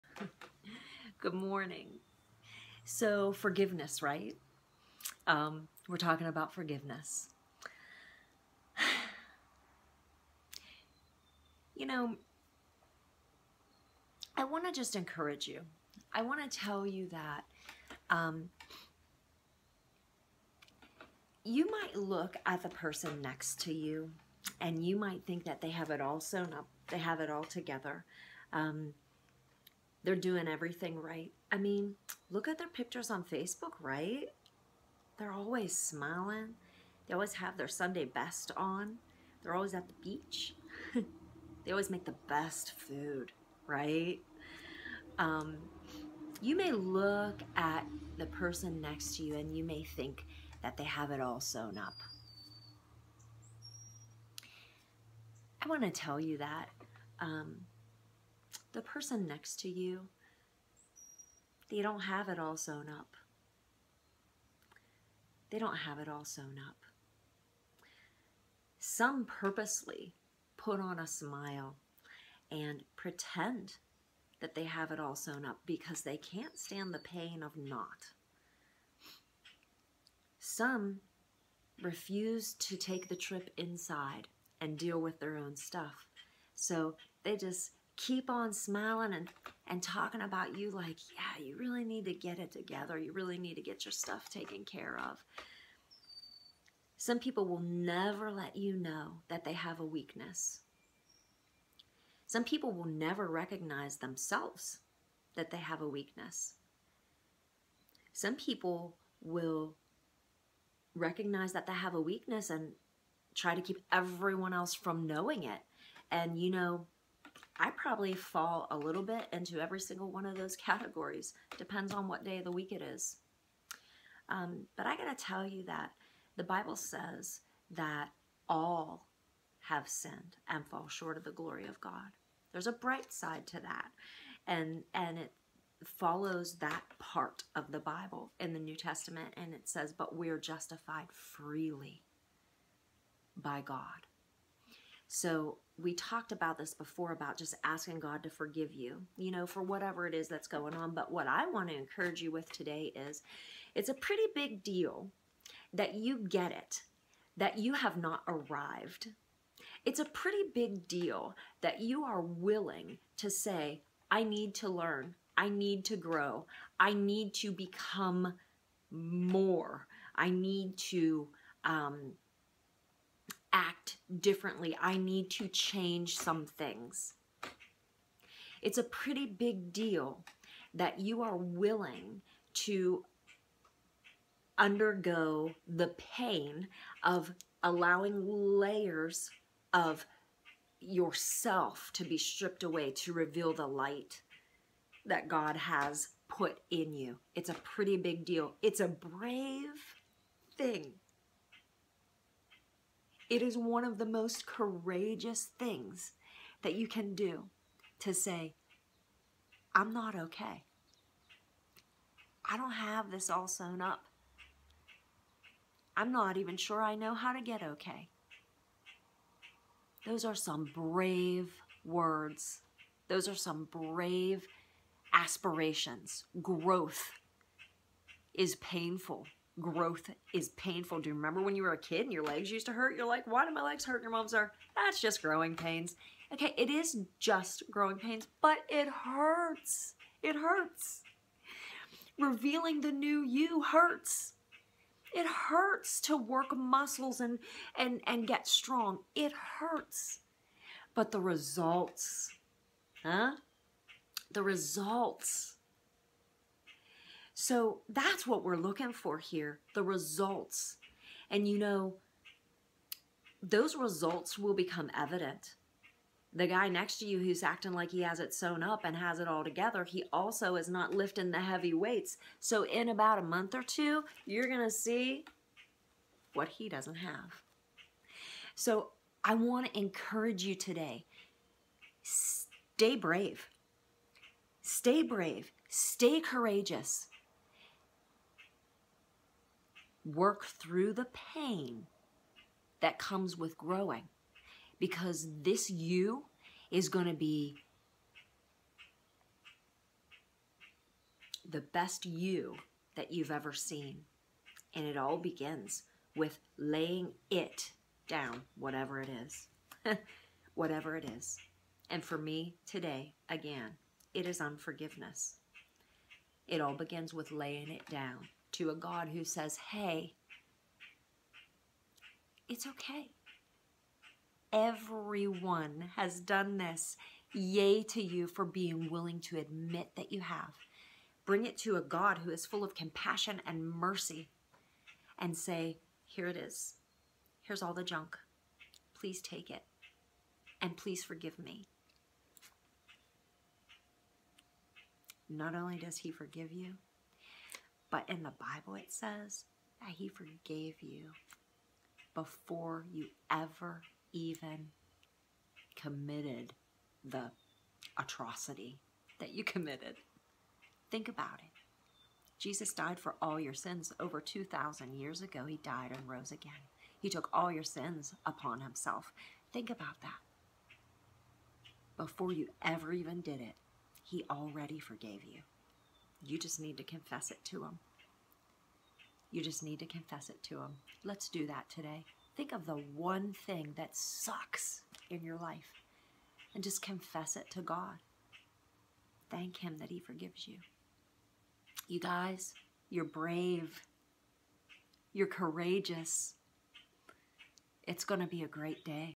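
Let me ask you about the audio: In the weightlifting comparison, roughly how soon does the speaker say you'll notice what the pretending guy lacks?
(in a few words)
a month or two.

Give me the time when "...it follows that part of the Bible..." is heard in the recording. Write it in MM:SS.
02:15.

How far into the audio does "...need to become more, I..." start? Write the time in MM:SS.
02:46.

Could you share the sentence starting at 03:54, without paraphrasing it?
your mom's are, that's just growing pains.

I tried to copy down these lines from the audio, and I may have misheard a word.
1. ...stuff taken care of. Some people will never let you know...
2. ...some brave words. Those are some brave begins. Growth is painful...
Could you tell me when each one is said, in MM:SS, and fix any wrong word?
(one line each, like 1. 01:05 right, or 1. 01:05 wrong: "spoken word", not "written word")
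1. 01:33 right
2. 03:40 wrong: "aspirations", not "begins".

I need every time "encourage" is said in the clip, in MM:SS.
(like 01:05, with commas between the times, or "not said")
00:14, 02:31, 04:39.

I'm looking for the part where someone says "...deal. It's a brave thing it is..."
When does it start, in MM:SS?
03:18.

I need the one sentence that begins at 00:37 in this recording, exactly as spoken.
They always have their Sunday best on.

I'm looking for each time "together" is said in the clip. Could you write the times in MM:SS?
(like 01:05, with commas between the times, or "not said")
00:27, 01:32, 04:29.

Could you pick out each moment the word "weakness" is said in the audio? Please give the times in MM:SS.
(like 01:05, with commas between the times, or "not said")
01:39, 01:45, 01:52.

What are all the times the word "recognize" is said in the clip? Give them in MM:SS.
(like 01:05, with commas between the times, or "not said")
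01:43, 01:50.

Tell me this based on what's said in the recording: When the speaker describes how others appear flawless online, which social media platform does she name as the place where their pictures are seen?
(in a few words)
Facebook.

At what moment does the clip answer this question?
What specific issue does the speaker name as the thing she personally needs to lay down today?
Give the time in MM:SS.
05:14.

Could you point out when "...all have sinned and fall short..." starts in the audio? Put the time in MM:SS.
02:08.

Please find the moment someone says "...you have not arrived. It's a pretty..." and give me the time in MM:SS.
02:37.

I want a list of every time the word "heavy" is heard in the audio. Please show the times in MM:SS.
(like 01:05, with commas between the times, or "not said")
04:31.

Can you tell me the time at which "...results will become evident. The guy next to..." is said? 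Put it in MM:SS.
04:23.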